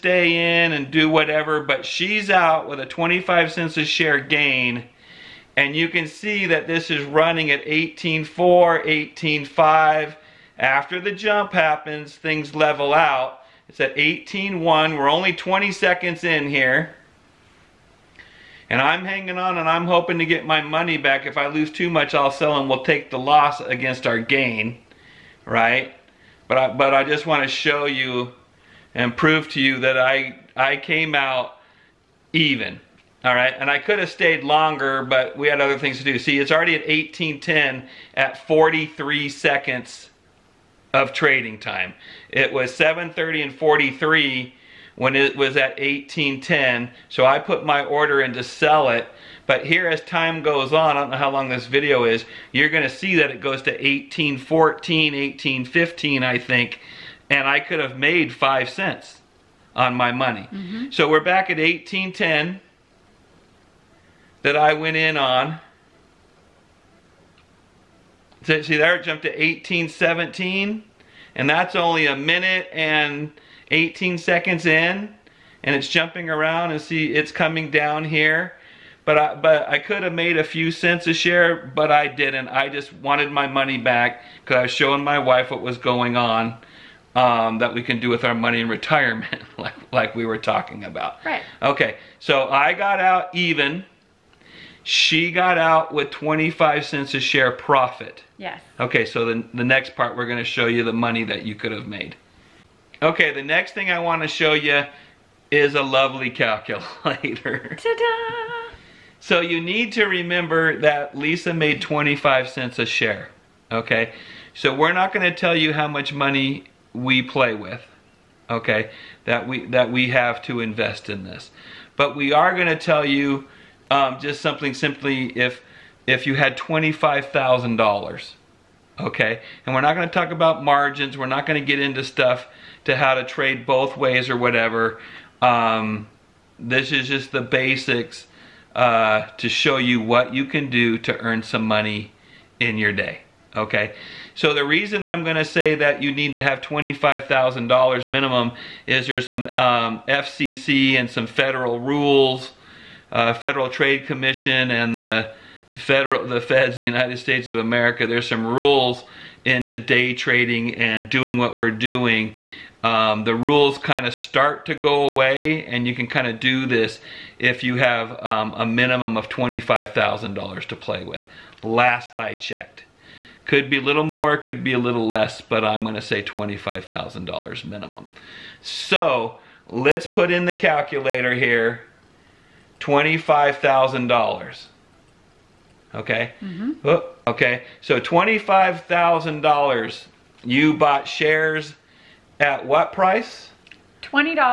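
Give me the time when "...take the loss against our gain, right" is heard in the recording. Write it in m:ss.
0:22.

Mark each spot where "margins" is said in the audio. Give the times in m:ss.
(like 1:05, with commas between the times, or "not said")
2:10.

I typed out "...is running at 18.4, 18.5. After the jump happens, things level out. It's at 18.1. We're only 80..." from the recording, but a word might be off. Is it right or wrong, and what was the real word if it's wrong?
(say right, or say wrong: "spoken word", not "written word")
wrong: "20", not "80".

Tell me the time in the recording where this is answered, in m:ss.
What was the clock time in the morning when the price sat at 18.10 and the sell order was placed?
0:42.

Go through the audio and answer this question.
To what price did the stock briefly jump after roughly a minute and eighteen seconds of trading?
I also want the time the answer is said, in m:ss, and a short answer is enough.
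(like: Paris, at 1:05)
18.17, at 1:09.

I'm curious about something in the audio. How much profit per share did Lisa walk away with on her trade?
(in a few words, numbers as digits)
25 cents.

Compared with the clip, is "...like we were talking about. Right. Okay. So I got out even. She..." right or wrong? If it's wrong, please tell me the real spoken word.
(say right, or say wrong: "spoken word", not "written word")
right.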